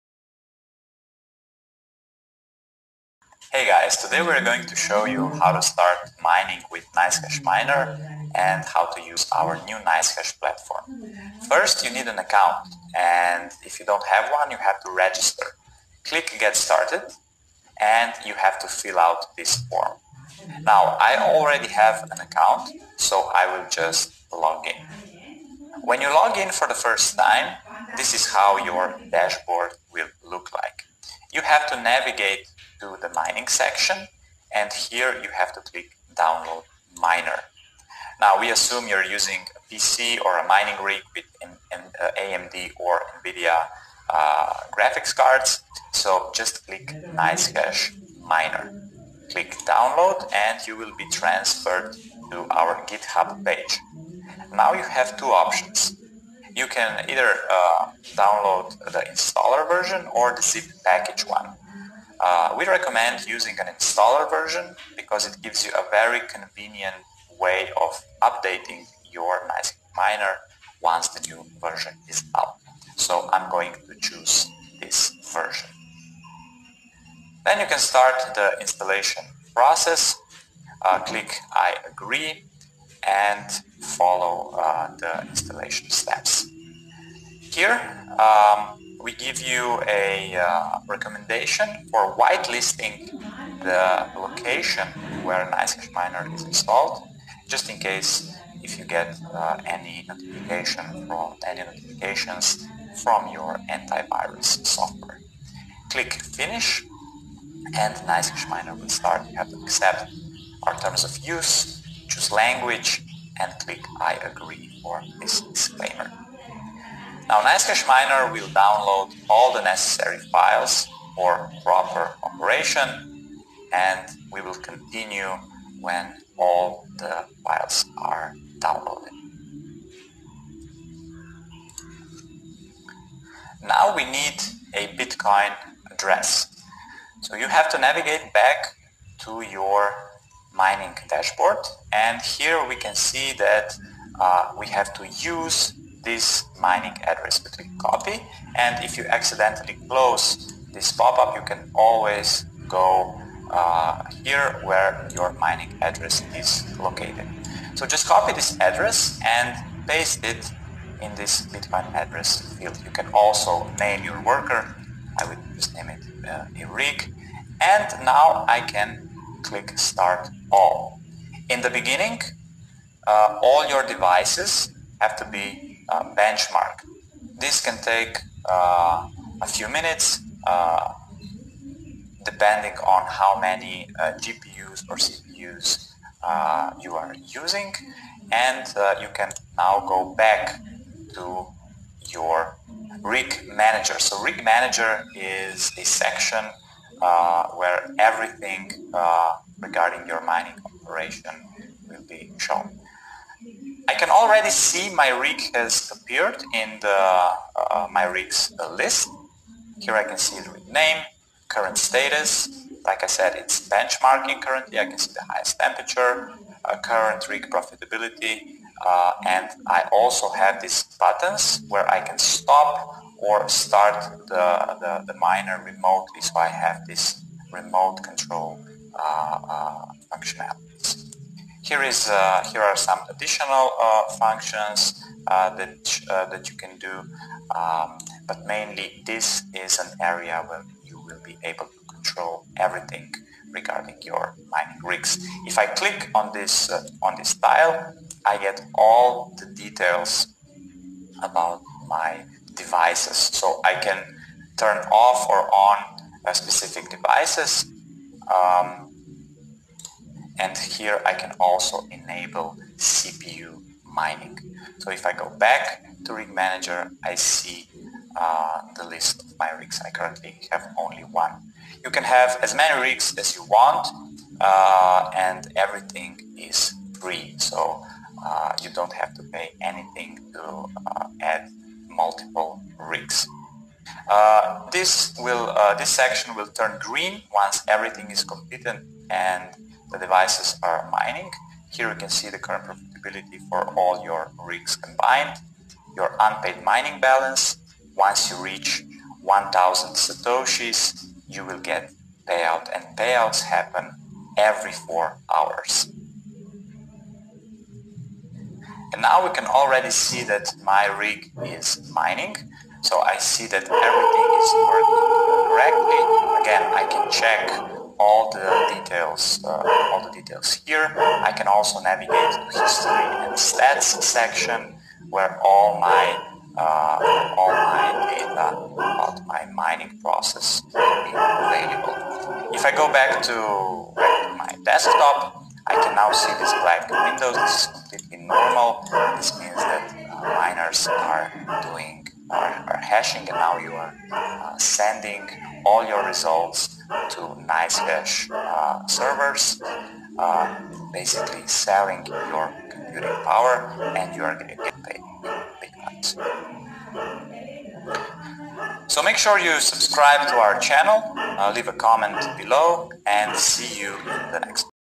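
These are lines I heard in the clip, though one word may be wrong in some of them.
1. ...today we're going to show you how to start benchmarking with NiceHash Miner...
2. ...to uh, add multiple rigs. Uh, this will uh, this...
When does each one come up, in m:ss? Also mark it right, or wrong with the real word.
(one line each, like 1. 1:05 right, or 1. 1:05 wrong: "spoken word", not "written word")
1. 0:03 wrong: "mining", not "benchmarking"
2. 4:40 right.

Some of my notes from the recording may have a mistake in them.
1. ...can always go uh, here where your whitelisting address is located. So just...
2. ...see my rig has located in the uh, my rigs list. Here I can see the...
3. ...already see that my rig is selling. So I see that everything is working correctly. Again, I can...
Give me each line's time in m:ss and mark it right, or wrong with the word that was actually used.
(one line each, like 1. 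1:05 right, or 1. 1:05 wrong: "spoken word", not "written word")
1. 2:31 wrong: "mining", not "whitelisting"
2. 3:24 wrong: "appeared", not "located"
3. 5:09 wrong: "mining", not "selling".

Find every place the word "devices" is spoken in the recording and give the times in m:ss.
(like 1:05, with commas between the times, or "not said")
2:53, 4:12, 4:16, 4:49.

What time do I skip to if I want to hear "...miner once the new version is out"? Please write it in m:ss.
1:09.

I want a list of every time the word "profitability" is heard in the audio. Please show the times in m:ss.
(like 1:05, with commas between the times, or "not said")
3:37, 4:52.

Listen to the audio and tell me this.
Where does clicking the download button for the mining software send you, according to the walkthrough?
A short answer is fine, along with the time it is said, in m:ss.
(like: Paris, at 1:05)
GitHub page, at 0:52.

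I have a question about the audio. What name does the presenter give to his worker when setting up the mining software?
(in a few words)
Eric.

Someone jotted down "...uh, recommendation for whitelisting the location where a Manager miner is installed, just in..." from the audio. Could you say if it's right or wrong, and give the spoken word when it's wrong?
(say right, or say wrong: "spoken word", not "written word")
wrong: "NiceHash", not "Manager".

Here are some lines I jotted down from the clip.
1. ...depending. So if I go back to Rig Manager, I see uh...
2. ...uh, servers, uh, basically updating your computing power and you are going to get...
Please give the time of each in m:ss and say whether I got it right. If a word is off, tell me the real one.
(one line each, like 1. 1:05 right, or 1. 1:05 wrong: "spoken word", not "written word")
1. 4:23 wrong: "mining", not "depending"
2. 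5:48 wrong: "selling", not "updating".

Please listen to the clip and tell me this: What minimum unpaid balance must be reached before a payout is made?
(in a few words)
1000 satoshis.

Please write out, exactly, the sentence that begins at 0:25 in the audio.
When you log in for the first time, this is how your dashboard will look like.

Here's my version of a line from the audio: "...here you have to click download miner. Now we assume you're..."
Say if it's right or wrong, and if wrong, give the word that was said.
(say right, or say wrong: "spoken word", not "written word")
right.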